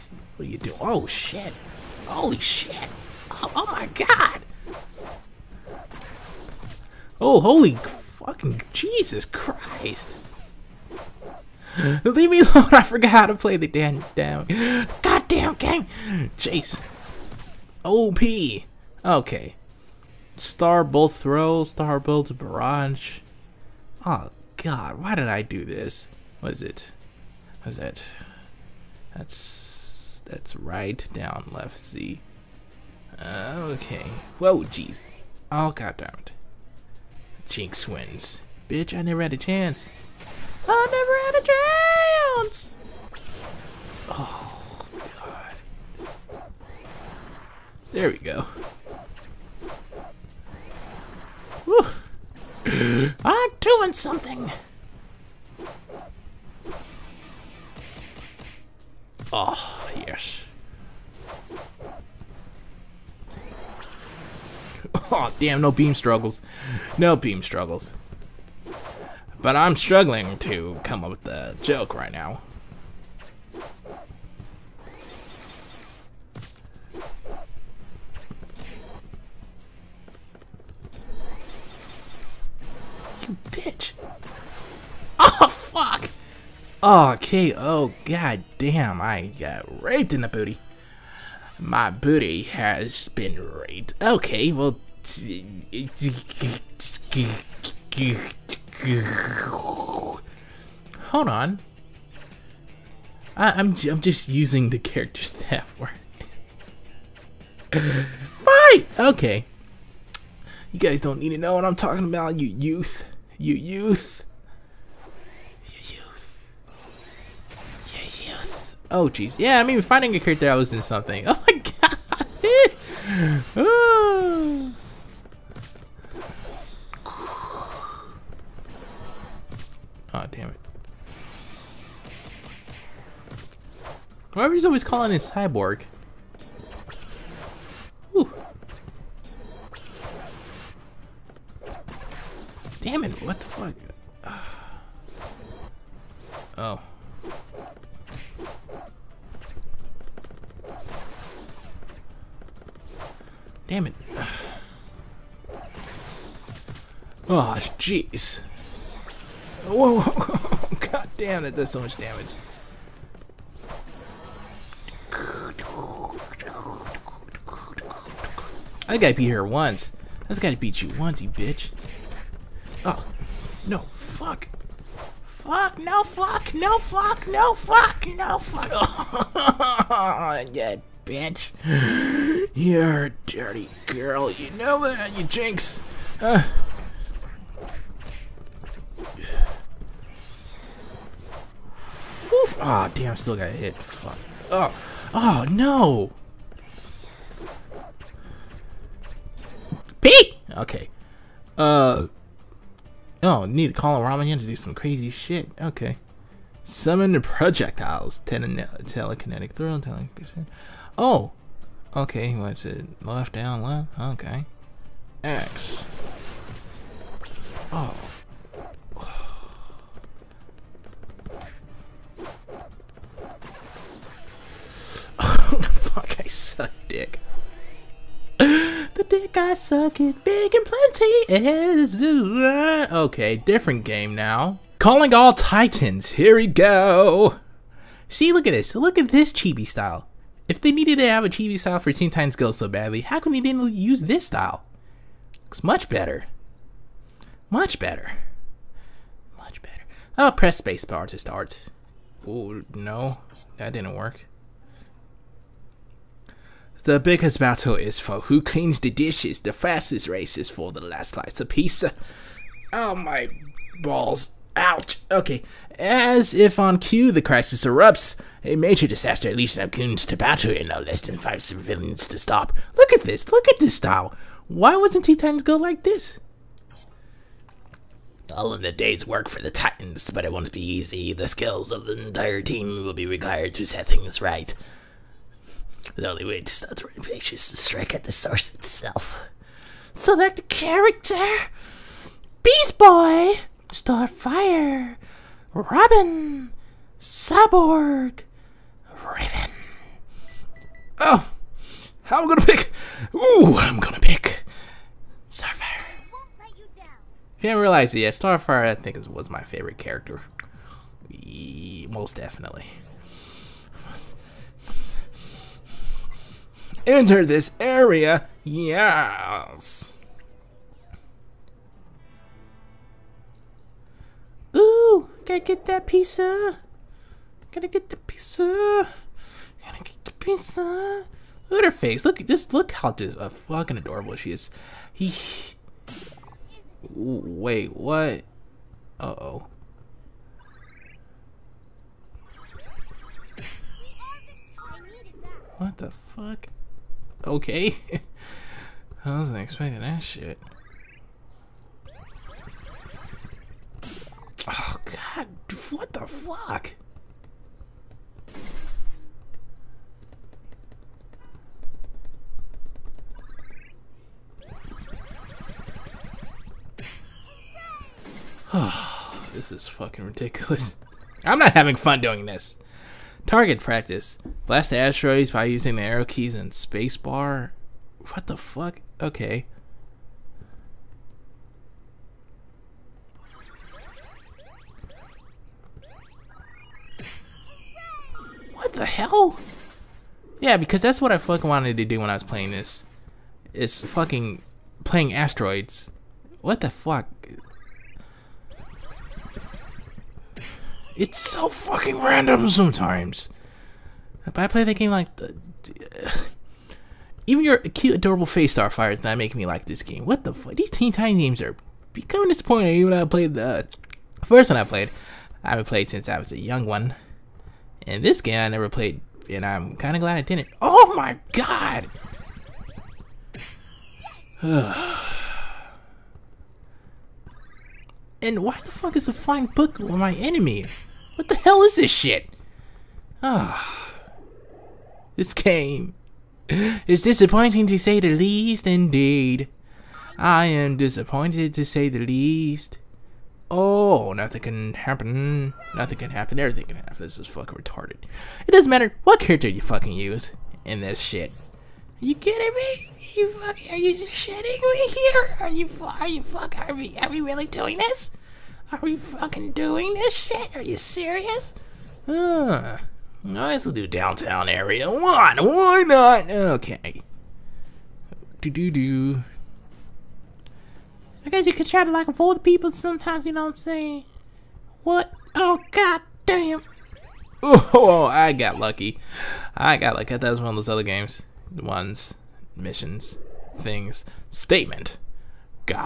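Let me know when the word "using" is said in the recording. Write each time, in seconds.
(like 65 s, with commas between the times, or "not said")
104 s, 375 s.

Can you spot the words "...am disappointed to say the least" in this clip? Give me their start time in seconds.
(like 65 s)
440 s.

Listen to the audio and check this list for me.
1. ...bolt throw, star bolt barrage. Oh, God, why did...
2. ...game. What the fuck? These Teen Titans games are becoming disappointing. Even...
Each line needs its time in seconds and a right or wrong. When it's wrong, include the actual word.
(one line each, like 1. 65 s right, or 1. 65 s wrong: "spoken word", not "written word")
1. 20 s right
2. 409 s right.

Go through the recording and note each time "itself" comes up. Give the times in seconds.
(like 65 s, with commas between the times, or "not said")
288 s.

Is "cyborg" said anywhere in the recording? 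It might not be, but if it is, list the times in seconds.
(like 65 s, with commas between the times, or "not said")
135 s, 296 s.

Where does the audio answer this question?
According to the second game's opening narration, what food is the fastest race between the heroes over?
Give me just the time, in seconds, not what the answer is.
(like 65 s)
260 s.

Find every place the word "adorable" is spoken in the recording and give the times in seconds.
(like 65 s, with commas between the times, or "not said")
333 s, 407 s.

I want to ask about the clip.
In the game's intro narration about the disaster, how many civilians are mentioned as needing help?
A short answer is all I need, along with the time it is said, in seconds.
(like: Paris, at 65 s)
5, at 271 s.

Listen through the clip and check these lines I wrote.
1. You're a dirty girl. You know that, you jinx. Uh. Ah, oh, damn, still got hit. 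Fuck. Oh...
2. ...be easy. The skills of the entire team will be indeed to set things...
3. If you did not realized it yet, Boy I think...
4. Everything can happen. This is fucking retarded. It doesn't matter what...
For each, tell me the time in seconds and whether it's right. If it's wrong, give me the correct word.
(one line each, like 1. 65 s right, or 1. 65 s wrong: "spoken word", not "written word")
1. 182 s right
2. 280 s wrong: "required", not "indeed"
3. 306 s wrong: "Starfire", not "Boy"
4. 446 s right.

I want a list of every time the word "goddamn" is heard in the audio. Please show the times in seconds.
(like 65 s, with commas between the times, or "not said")
15 s, 35 s.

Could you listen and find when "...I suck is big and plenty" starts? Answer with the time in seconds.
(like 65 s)
229 s.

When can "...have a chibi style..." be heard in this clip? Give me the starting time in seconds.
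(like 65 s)
241 s.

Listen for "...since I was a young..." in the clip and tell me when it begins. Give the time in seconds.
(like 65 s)
415 s.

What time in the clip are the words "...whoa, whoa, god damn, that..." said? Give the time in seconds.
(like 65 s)
159 s.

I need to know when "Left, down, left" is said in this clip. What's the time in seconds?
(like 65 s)
213 s.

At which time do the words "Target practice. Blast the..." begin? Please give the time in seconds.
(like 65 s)
373 s.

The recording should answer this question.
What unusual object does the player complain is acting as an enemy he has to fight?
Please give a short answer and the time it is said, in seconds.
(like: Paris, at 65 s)
A flying book, at 429 s.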